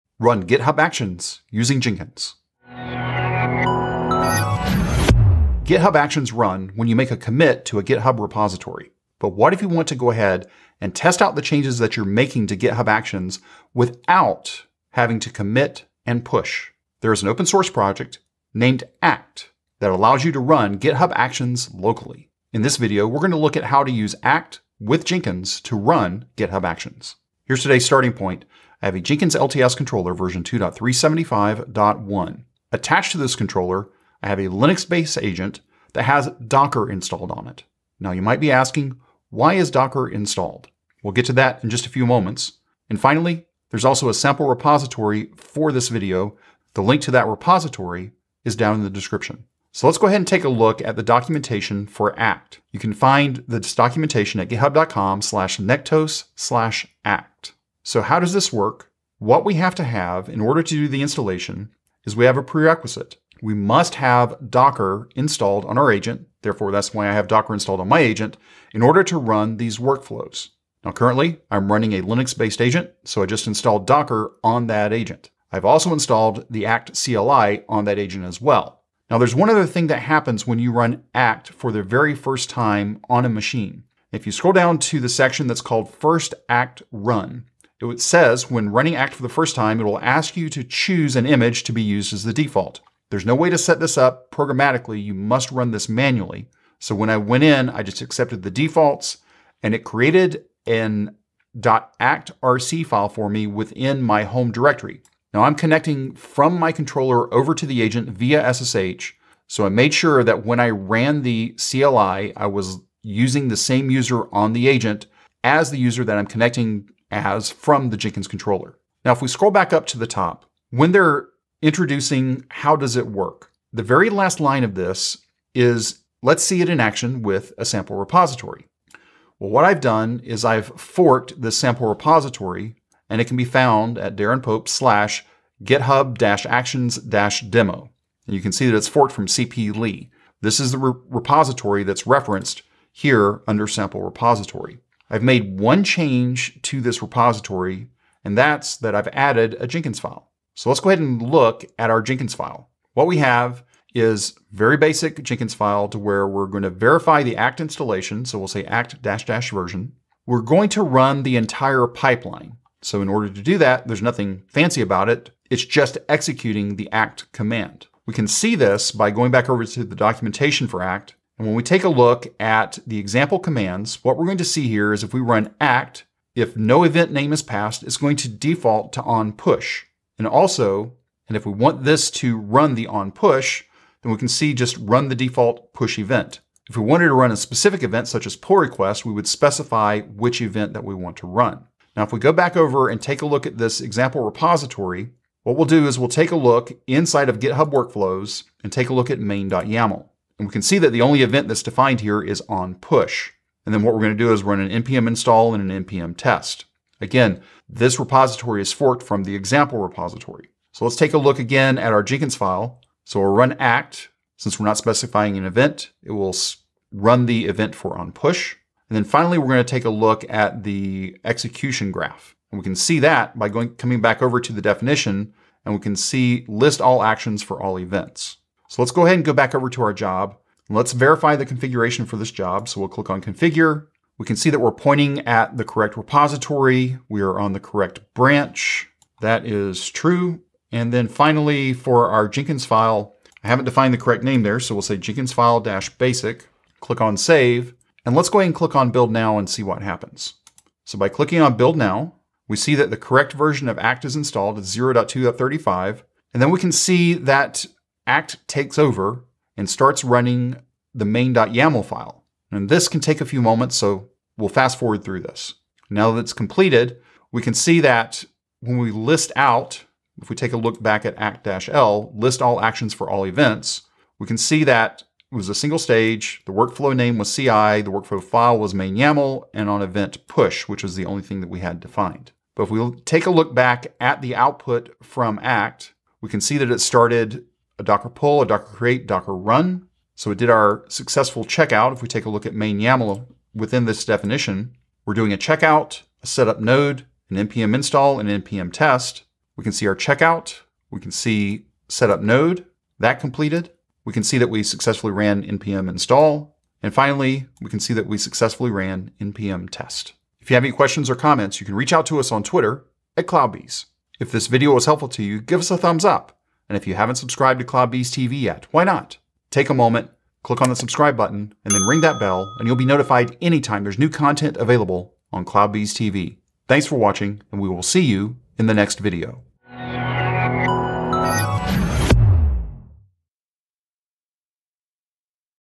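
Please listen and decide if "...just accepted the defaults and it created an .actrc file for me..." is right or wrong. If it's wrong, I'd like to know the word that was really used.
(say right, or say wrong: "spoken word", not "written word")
right.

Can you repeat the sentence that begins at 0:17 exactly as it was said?
There is an open source project named ACT that allows you to run GitHub Actions locally.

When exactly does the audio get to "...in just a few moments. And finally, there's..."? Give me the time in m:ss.
0:41.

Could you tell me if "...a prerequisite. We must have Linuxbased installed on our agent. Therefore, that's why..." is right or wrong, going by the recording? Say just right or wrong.
wrong.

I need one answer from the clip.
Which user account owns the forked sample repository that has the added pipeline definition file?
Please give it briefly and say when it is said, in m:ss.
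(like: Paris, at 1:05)
Pope, at 2:14.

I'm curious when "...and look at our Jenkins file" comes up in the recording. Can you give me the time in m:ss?
2:31.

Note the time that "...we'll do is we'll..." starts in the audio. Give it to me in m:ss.
3:15.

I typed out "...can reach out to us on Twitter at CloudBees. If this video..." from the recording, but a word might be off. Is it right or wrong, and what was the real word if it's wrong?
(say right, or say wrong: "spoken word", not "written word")
right.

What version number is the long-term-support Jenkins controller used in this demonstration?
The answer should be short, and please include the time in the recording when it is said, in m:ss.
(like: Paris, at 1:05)
2.375.1, at 0:30.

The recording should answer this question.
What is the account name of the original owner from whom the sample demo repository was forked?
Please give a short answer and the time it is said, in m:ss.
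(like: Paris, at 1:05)
cplee, at 2:19.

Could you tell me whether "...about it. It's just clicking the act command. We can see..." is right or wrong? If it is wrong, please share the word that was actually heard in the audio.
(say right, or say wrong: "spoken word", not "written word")
wrong: "executing", not "clicking".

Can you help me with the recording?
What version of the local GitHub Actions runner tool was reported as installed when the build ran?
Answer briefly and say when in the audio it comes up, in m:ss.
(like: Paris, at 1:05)
0.2.35, at 4:14.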